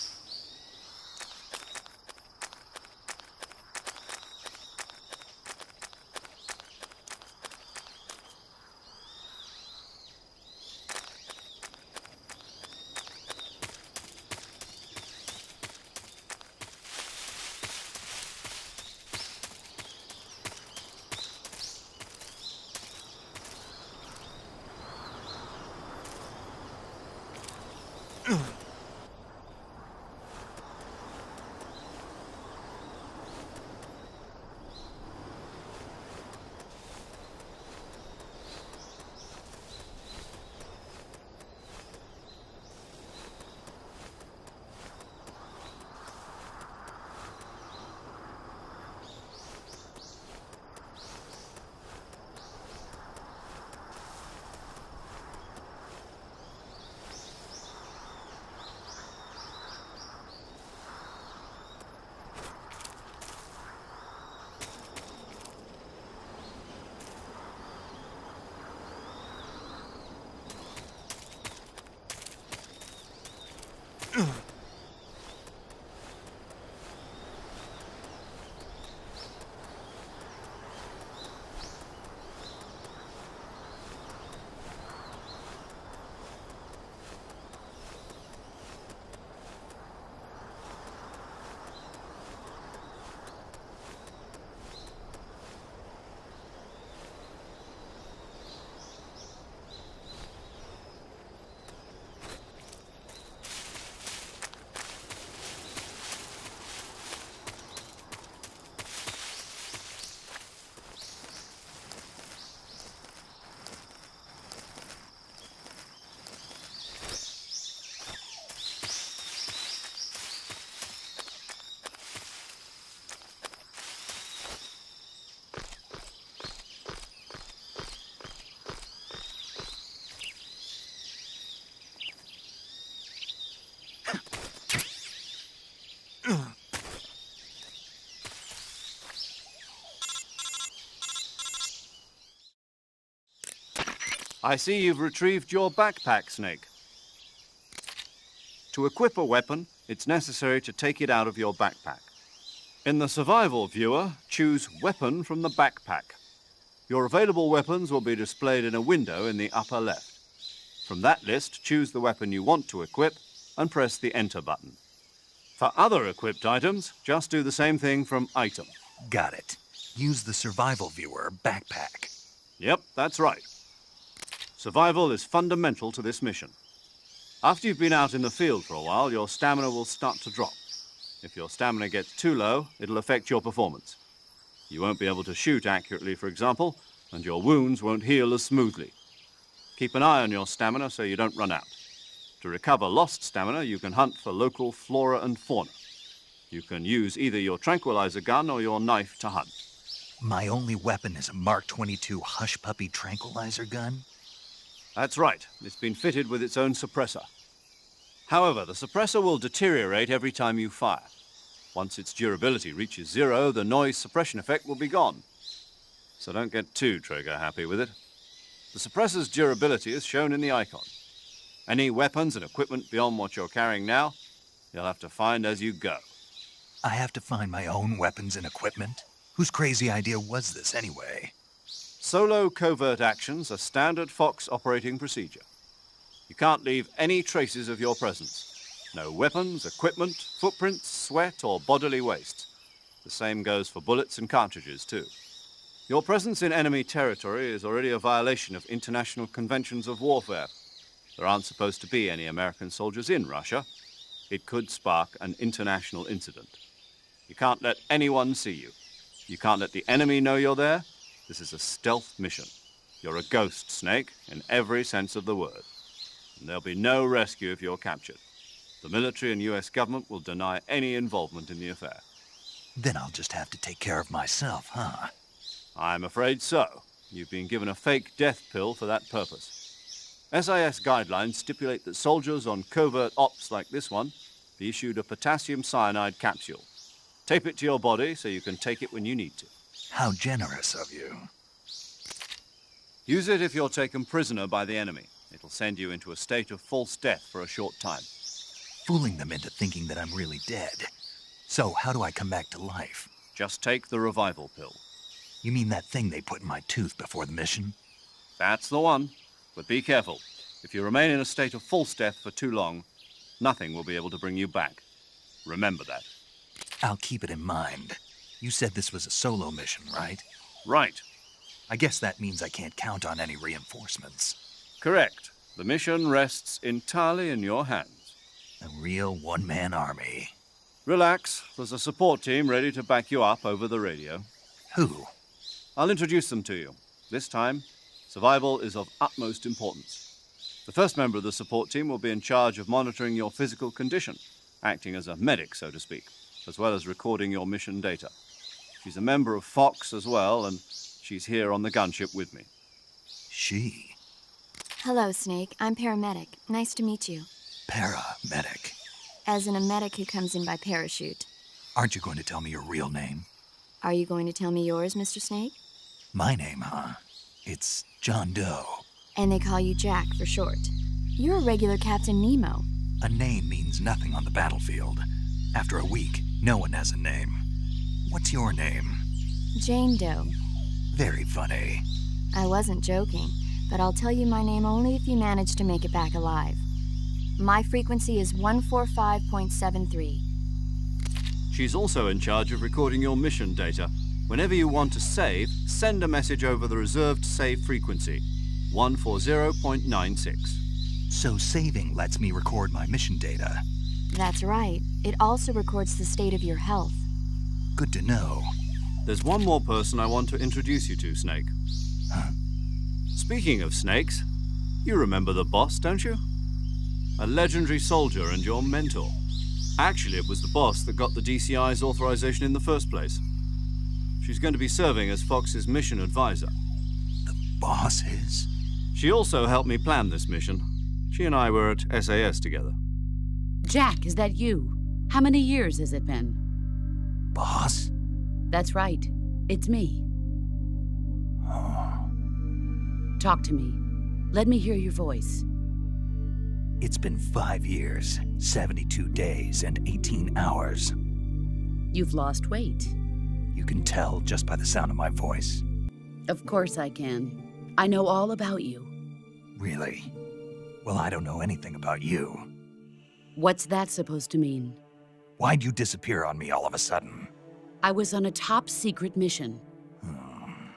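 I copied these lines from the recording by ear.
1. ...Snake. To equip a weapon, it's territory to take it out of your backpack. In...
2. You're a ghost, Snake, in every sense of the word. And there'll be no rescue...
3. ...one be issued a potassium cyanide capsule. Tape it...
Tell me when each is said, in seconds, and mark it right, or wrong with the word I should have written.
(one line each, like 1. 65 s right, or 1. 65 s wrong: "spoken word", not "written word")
1. 146 s wrong: "necessary", not "territory"
2. 262 s right
3. 283 s right.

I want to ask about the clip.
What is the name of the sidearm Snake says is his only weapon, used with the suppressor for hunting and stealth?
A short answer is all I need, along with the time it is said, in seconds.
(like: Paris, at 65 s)
Mark 22, at 201 s.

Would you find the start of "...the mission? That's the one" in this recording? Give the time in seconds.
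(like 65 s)
307 s.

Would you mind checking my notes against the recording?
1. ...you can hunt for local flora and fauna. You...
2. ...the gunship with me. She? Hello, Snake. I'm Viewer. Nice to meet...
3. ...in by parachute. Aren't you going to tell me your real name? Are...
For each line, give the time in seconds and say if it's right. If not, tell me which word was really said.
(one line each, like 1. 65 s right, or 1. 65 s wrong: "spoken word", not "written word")
1. 193 s right
2. 351 s wrong: "Paramedic", not "Viewer"
3. 360 s right.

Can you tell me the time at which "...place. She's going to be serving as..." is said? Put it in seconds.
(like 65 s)
422 s.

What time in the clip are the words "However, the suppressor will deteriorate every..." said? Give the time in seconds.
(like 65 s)
208 s.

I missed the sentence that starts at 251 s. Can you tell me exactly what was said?
There aren't supposed to be any American soldiers in Russia.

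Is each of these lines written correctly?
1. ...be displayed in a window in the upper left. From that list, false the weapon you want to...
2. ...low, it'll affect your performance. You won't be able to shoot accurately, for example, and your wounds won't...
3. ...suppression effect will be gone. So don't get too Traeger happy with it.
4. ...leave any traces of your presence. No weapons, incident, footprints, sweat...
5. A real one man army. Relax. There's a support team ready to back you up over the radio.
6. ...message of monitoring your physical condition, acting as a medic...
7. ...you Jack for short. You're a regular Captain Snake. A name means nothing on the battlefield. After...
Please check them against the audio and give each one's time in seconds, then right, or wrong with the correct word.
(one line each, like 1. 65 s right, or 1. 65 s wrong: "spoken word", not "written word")
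1. 158 s wrong: "choose", not "false"
2. 182 s right
3. 213 s right
4. 236 s wrong: "equipment", not "incident"
5. 328 s right
6. 342 s wrong: "charge", not "message"
7. 369 s wrong: "Nemo", not "Snake".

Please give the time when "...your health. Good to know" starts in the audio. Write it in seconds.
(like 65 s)
406 s.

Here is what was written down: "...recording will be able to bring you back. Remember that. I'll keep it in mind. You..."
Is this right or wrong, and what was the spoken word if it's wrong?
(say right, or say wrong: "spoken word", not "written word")
wrong: "nothing", not "recording".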